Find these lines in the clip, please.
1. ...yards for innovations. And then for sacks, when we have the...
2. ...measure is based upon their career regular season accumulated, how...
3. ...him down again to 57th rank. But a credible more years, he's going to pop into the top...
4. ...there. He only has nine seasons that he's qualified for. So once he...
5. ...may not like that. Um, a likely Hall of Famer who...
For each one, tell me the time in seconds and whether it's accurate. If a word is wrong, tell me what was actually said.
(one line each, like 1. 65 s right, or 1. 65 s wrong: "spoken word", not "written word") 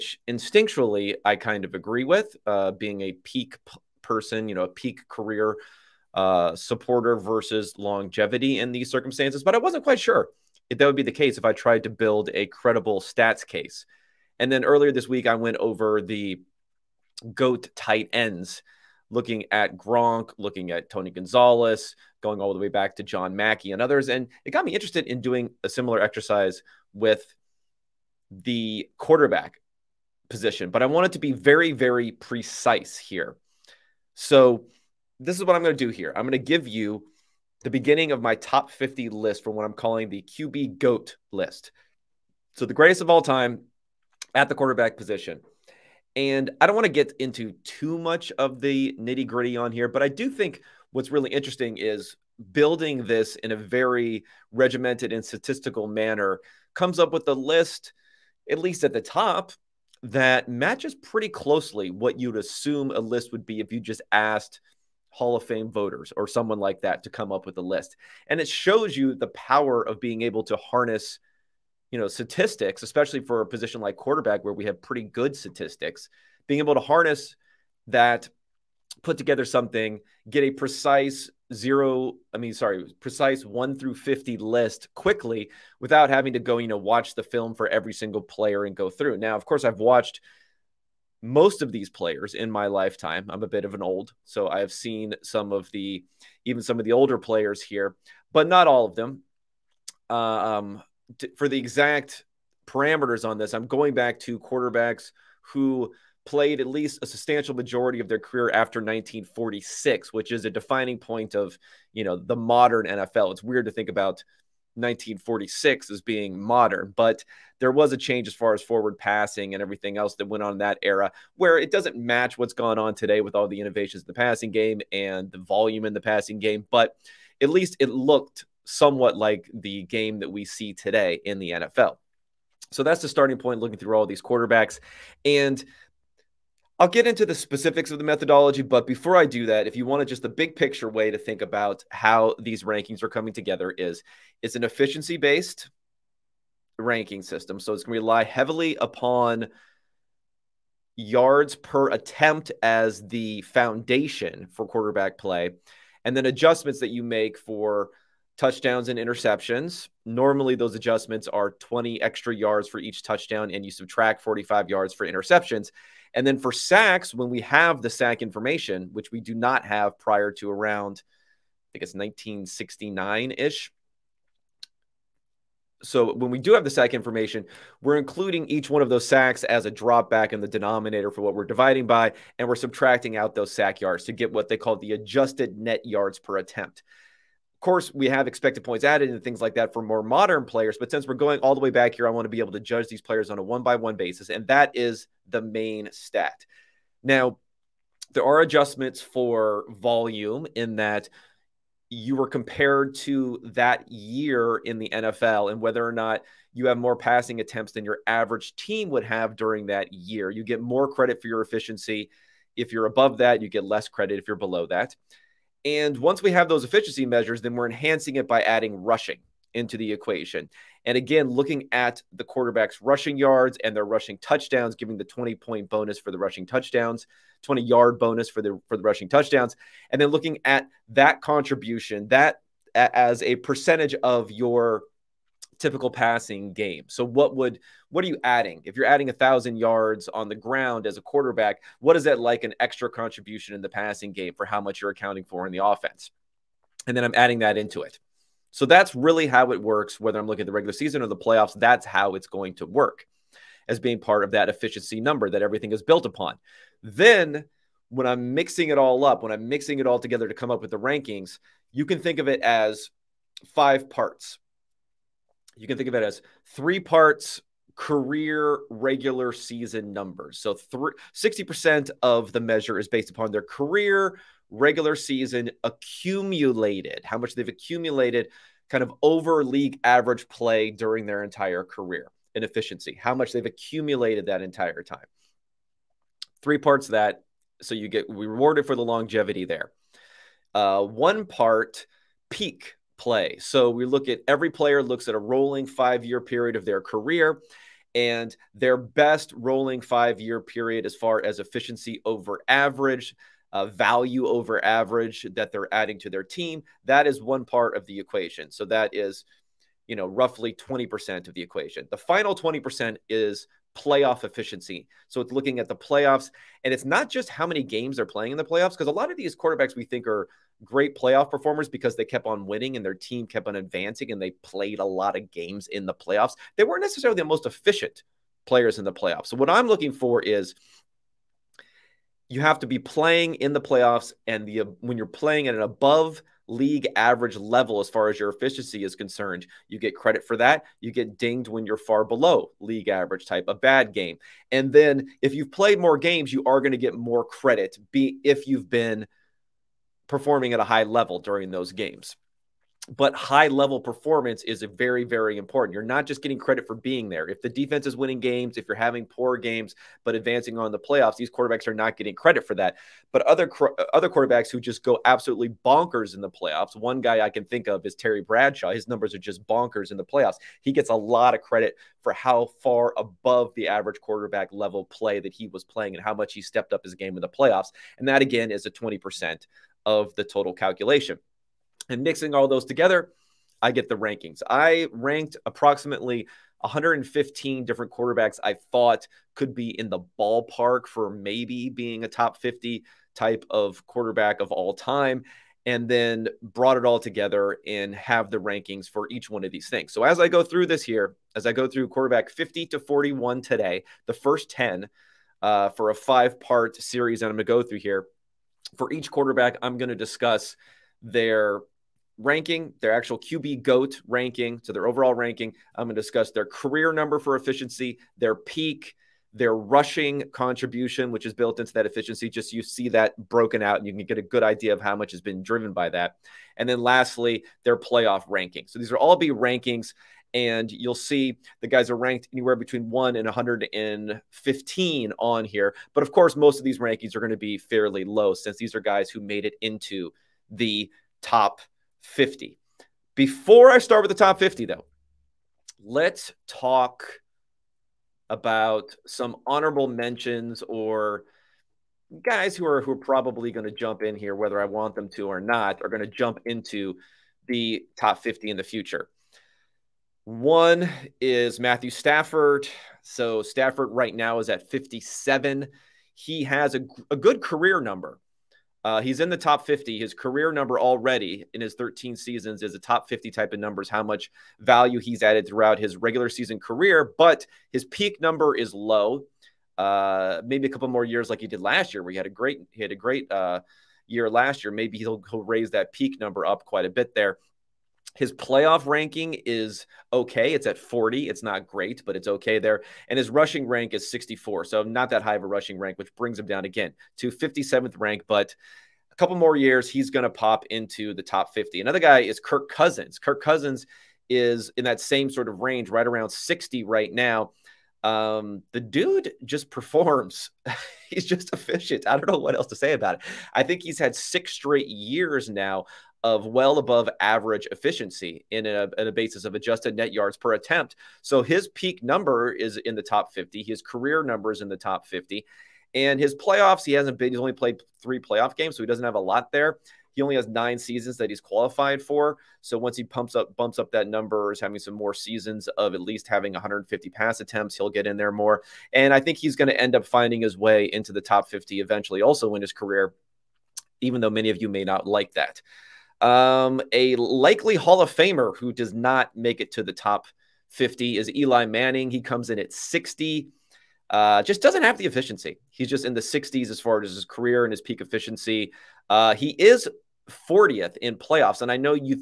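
1. 164 s wrong: "interceptions", not "innovations"
2. 272 s right
3. 496 s wrong: "couple", not "credible"
4. 529 s right
5. 544 s right.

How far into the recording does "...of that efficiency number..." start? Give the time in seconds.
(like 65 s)
254 s.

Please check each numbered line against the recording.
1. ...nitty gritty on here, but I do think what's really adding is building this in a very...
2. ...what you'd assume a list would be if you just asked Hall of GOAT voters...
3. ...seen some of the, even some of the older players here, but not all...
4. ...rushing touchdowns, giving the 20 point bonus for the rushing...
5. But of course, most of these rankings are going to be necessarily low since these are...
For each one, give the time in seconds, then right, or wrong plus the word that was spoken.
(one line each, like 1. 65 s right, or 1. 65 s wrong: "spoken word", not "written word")
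1. 48 s wrong: "interesting", not "adding"
2. 61 s wrong: "Fame", not "GOAT"
3. 94 s right
4. 223 s right
5. 435 s wrong: "fairly", not "necessarily".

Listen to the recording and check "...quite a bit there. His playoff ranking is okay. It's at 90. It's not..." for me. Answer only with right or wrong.
wrong.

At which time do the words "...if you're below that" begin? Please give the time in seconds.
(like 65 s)
214 s.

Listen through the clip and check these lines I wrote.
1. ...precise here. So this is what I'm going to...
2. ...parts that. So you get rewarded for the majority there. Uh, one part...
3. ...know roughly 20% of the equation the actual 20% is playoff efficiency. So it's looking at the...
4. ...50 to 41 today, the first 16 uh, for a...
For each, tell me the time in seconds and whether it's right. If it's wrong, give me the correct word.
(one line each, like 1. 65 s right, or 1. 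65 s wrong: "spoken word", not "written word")
1. 32 s right
2. 286 s wrong: "longevity", not "majority"
3. 309 s wrong: "final", not "actual"
4. 402 s wrong: "10", not "16".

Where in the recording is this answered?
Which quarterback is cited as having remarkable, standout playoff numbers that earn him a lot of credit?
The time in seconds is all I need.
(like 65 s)
367 s.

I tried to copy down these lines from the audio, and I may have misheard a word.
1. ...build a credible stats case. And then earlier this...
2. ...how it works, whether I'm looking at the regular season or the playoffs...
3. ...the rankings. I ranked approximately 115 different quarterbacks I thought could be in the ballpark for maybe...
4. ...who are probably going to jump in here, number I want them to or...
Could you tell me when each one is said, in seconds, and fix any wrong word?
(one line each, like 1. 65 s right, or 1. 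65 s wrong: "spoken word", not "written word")
1. 11 s right
2. 249 s right
3. 383 s right
4. 452 s wrong: "whether", not "number".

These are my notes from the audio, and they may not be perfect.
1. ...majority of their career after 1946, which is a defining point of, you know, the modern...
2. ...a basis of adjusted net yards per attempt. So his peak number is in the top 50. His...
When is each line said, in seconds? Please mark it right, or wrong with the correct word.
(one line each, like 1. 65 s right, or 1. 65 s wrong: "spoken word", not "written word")
1. 107 s right
2. 519 s right.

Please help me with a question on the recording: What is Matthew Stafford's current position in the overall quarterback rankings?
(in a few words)
57.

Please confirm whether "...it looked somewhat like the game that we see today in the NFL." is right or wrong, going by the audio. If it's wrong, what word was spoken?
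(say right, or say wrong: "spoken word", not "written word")
right.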